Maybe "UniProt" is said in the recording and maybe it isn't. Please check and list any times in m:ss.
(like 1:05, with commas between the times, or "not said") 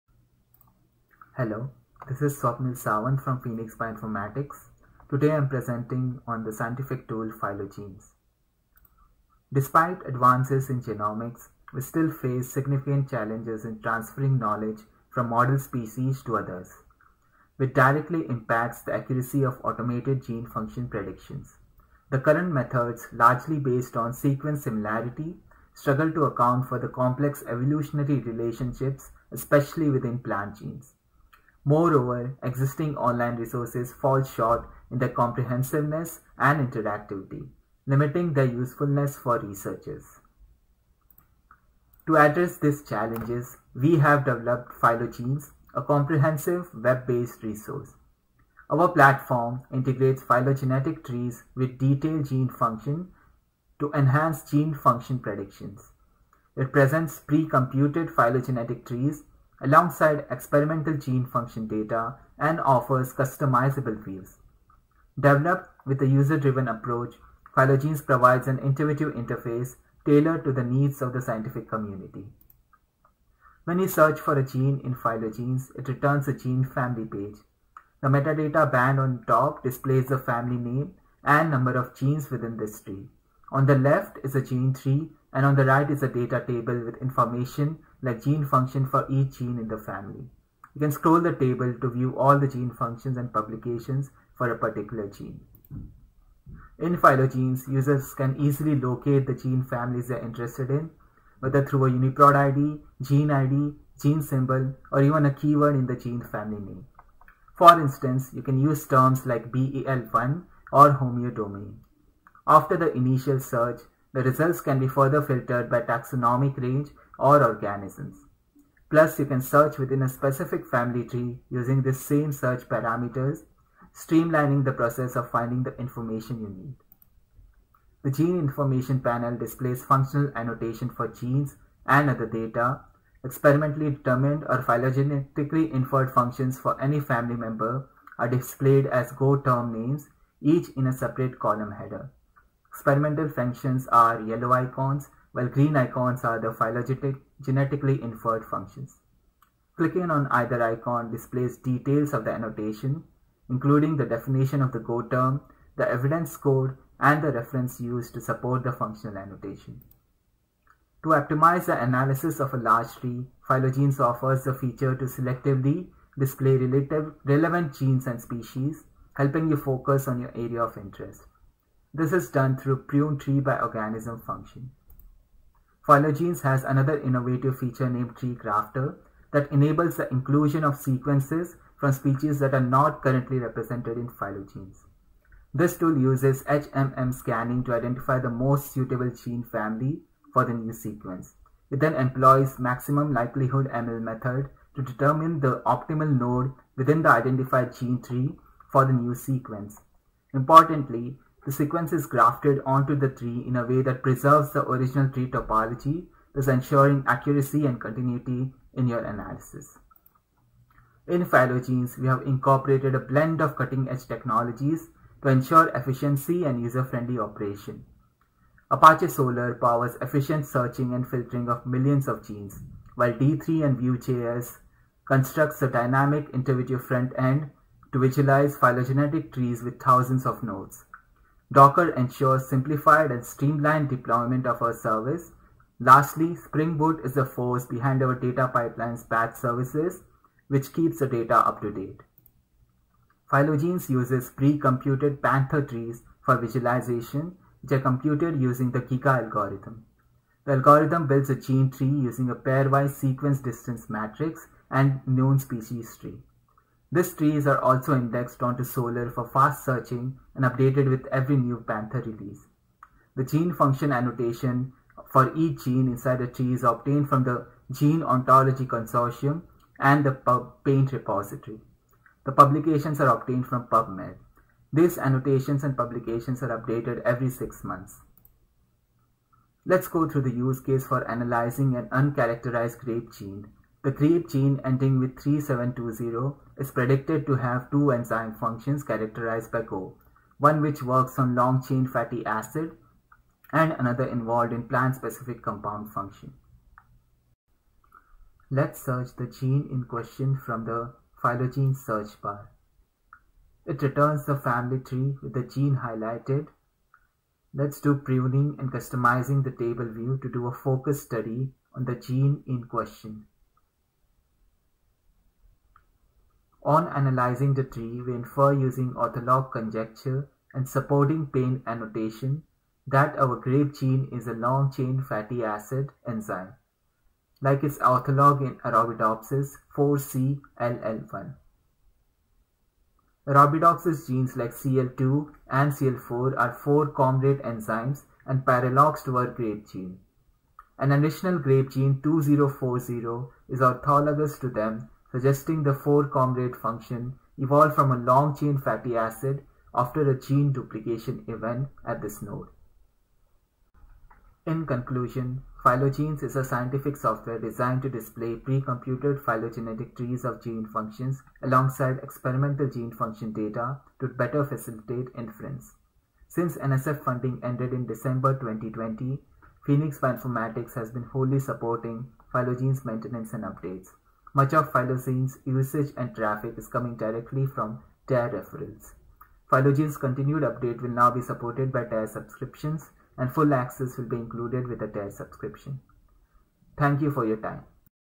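1:41.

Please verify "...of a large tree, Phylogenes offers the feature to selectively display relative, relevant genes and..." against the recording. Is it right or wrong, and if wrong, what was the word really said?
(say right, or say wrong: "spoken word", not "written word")
right.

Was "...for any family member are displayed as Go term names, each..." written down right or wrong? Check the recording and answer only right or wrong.
right.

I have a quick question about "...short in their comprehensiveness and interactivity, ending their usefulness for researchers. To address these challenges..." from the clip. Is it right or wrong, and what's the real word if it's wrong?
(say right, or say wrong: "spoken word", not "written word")
wrong: "limiting", not "ending".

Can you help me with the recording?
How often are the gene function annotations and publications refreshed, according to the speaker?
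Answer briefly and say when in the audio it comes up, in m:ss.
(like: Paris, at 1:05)
Every 6 months, at 4:37.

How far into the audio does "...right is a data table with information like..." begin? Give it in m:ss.
1:25.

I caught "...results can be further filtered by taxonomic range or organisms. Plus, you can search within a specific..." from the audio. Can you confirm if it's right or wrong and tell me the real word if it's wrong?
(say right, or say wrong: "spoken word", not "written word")
right.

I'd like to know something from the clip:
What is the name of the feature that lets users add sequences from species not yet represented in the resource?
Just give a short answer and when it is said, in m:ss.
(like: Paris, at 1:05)
TreeGrafter, at 2:58.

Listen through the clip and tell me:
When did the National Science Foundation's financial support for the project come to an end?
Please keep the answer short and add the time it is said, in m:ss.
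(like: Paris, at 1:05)
December 2020, at 6:07.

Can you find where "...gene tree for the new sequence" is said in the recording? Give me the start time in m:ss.
3:17.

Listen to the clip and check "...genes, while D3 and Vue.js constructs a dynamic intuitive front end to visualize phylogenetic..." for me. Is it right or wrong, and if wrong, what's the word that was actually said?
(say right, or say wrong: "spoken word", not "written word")
right.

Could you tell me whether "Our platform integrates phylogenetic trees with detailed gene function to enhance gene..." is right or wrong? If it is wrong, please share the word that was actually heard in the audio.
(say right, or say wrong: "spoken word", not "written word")
right.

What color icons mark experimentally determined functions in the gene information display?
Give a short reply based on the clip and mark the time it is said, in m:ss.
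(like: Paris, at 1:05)
Yellow, at 2:24.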